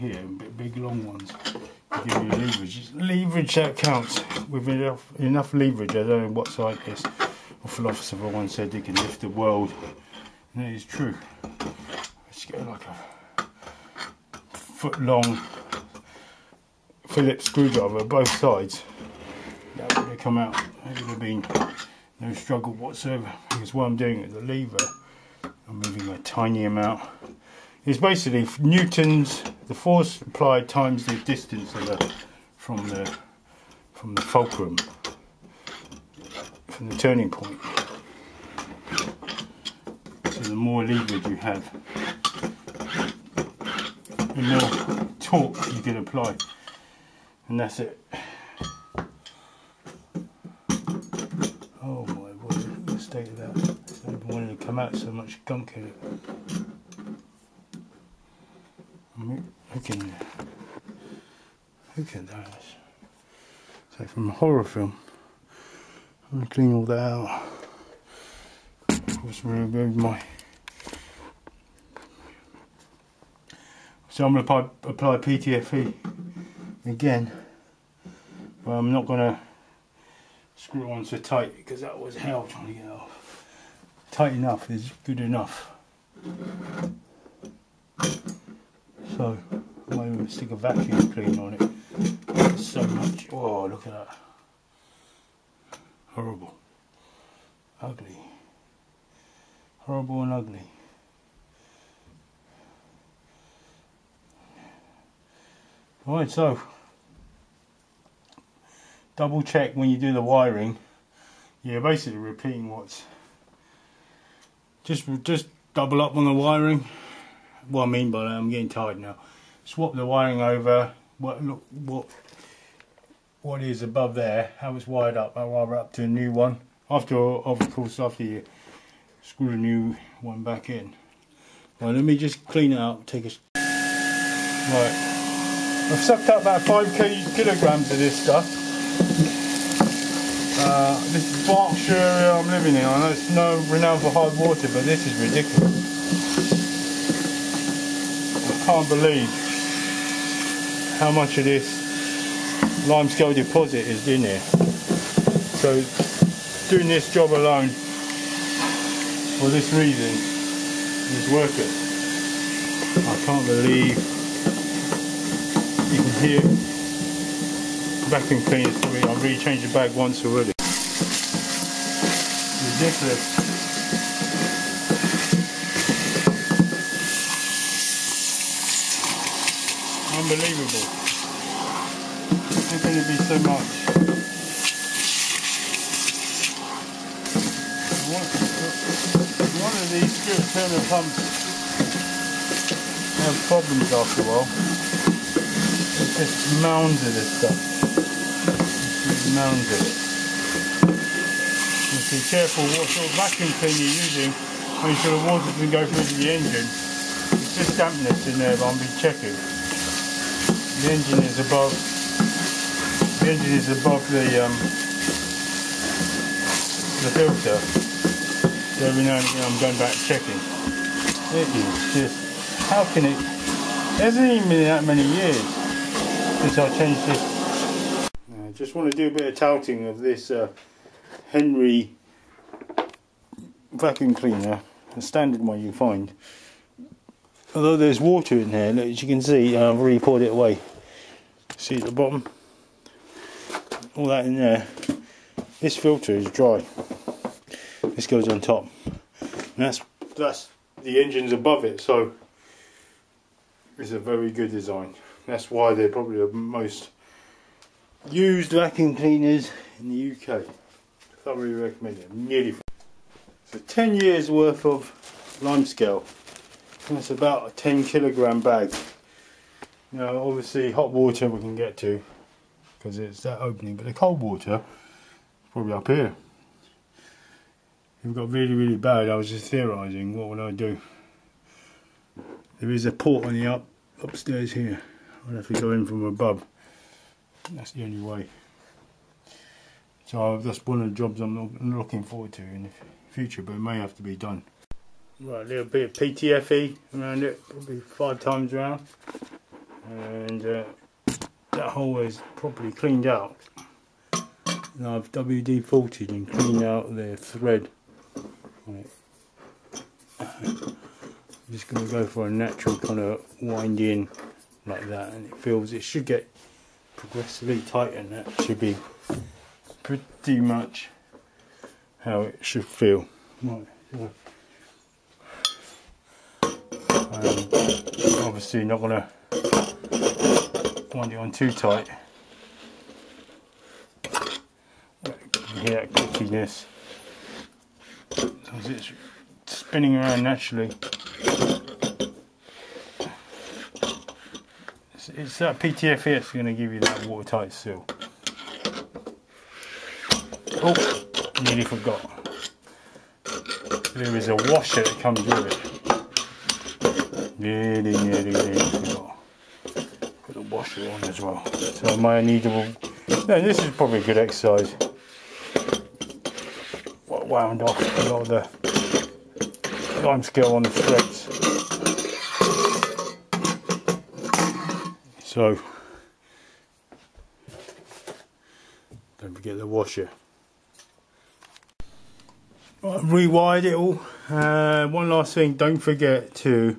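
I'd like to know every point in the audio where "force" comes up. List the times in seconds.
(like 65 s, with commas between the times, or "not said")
29 s.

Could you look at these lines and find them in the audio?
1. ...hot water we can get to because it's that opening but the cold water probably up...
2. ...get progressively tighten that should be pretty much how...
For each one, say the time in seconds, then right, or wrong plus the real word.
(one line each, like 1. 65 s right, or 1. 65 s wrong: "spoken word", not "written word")
1. 270 s right
2. 316 s right.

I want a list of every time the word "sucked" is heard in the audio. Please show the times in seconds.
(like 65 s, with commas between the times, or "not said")
135 s.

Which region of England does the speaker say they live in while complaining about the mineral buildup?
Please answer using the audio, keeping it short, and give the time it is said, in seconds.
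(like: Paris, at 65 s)
Berkshire, at 141 s.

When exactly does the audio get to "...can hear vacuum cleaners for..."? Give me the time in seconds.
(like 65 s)
166 s.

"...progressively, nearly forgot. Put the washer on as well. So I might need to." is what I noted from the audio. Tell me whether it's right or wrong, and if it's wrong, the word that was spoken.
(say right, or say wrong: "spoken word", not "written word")
wrong: "nearly", not "progressively".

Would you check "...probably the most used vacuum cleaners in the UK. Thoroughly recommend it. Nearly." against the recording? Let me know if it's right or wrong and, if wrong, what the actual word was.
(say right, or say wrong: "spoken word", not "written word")
right.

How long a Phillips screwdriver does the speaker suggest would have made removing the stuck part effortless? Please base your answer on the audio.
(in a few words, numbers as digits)
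a foot long.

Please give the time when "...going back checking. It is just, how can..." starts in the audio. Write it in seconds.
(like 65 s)
219 s.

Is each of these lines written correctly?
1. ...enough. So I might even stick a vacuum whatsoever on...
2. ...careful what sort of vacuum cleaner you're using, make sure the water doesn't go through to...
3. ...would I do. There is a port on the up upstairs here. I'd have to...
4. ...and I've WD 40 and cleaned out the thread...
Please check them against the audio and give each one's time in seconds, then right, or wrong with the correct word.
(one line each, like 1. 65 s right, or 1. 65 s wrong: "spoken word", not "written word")
1. 85 s wrong: "cleaner", not "whatsoever"
2. 202 s right
3. 280 s right
4. 304 s right.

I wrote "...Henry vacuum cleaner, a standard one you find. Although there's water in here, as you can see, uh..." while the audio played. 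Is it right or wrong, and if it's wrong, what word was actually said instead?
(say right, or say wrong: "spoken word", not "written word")
right.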